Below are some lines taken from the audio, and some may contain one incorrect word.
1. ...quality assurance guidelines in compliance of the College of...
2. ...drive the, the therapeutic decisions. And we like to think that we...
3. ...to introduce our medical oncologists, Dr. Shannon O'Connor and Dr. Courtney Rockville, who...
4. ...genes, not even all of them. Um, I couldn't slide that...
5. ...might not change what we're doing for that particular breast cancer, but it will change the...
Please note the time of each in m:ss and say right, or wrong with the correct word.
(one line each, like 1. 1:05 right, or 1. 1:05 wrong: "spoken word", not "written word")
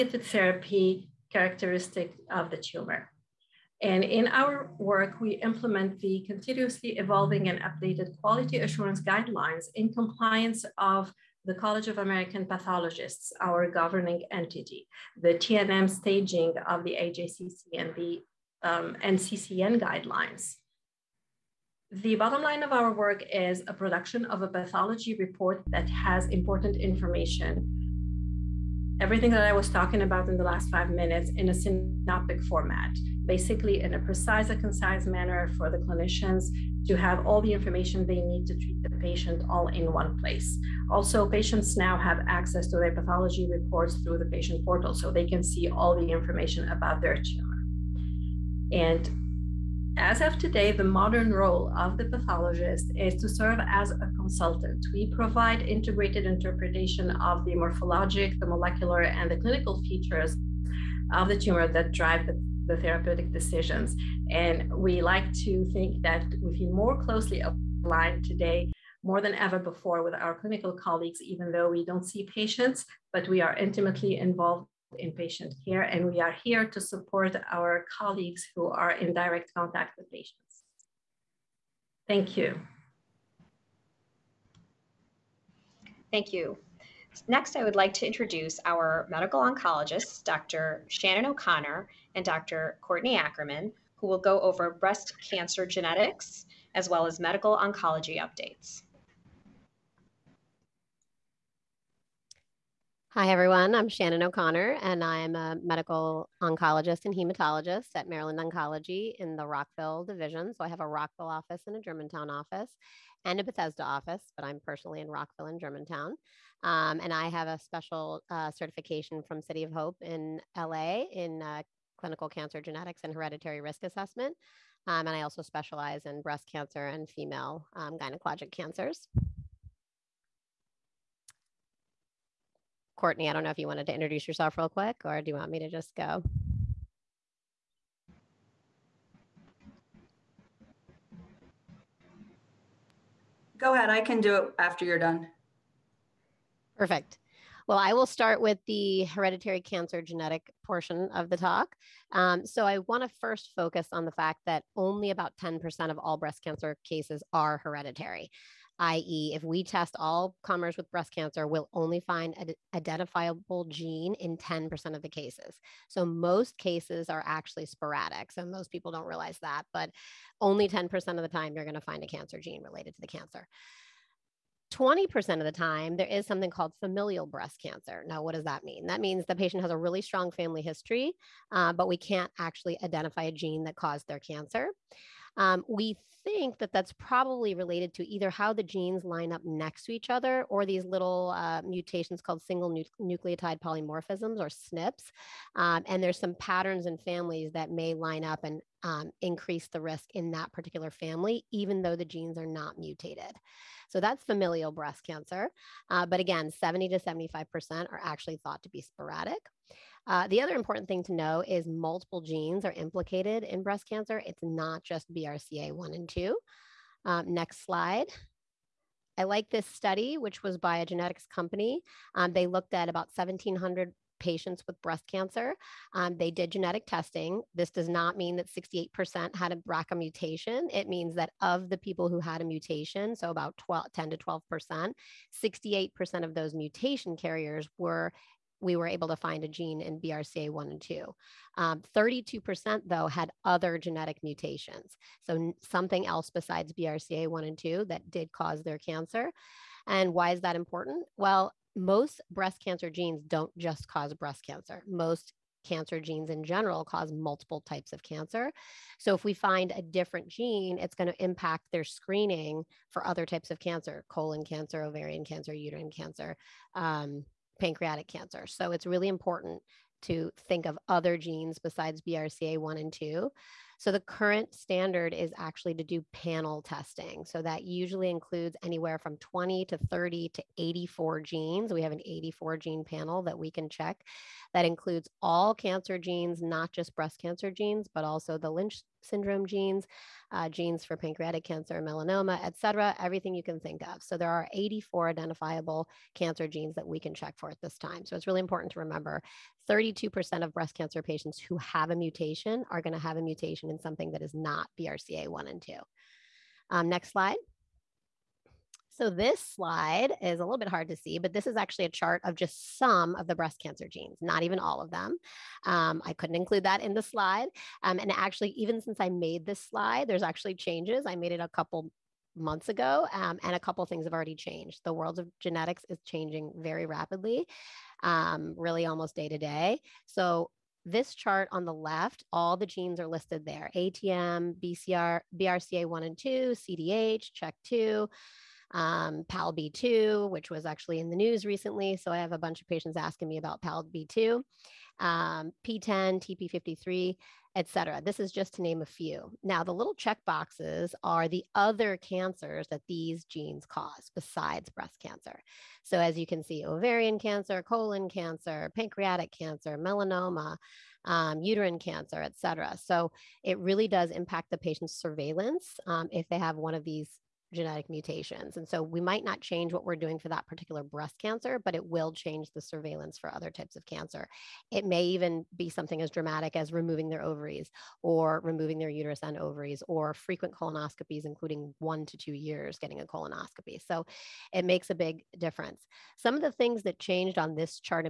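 1. 0:08 right
2. 1:01 right
3. 1:27 wrong: "Ackerman", not "Rockville"
4. 5:13 wrong: "include", not "slide"
5. 6:09 right.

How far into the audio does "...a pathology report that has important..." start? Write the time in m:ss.
0:24.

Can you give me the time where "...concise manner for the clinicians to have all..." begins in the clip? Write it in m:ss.
0:34.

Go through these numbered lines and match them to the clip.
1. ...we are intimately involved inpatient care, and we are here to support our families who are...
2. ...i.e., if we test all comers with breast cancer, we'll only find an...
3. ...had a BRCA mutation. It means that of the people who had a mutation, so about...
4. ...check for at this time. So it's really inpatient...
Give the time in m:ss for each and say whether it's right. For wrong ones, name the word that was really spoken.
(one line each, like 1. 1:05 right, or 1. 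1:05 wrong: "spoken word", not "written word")
1. 1:13 wrong: "colleagues", not "families"
2. 2:38 right
3. 3:49 right
4. 4:57 wrong: "important", not "inpatient".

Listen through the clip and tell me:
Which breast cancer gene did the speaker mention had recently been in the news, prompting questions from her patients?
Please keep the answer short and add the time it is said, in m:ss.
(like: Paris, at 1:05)
PALB2, at 5:39.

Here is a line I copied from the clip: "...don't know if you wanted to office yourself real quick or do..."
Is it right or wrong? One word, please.
wrong.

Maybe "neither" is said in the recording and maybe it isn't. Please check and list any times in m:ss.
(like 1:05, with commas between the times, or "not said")
not said.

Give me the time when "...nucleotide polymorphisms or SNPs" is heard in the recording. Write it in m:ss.
3:12.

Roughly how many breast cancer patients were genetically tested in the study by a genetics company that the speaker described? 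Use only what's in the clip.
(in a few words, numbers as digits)
1,700.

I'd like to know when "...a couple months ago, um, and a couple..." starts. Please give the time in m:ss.
5:21.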